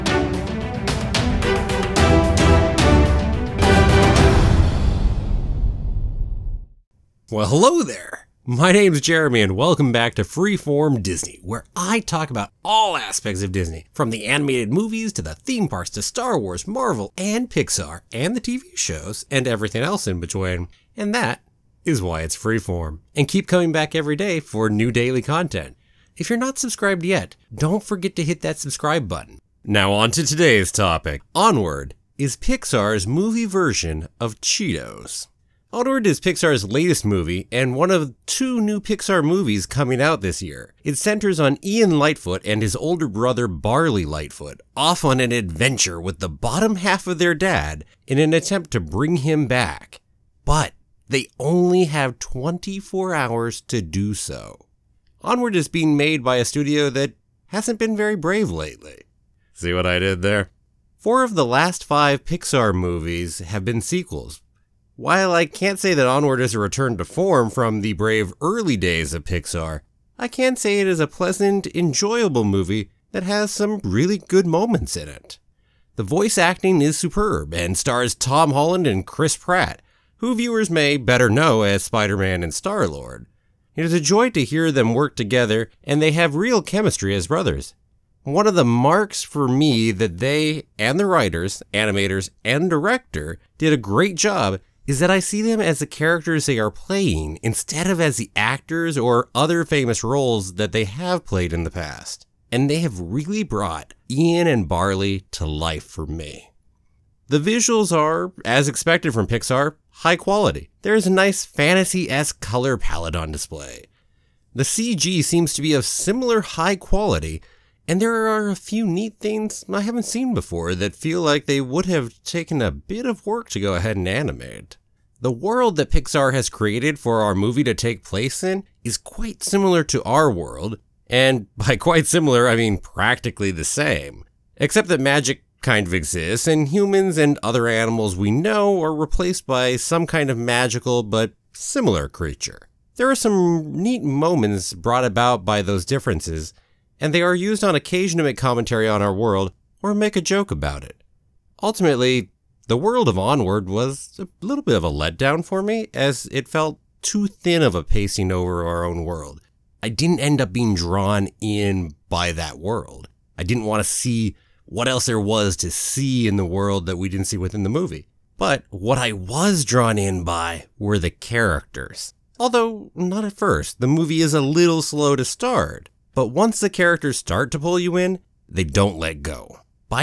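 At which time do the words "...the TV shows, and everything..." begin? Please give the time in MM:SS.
00:18.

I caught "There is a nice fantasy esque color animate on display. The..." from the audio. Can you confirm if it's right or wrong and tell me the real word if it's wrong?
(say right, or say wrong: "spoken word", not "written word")
wrong: "palette", not "animate".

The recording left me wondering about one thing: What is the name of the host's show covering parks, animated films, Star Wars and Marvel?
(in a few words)
Freeform Disney.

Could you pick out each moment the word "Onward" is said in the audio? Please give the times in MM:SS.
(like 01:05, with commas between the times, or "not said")
00:31, 00:35, 00:55, 01:06, 02:33.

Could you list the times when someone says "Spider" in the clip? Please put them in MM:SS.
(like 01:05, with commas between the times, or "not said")
01:21.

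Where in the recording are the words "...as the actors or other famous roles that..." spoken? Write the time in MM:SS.
01:38.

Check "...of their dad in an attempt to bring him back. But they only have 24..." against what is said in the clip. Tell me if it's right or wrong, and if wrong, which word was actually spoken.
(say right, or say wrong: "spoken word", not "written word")
right.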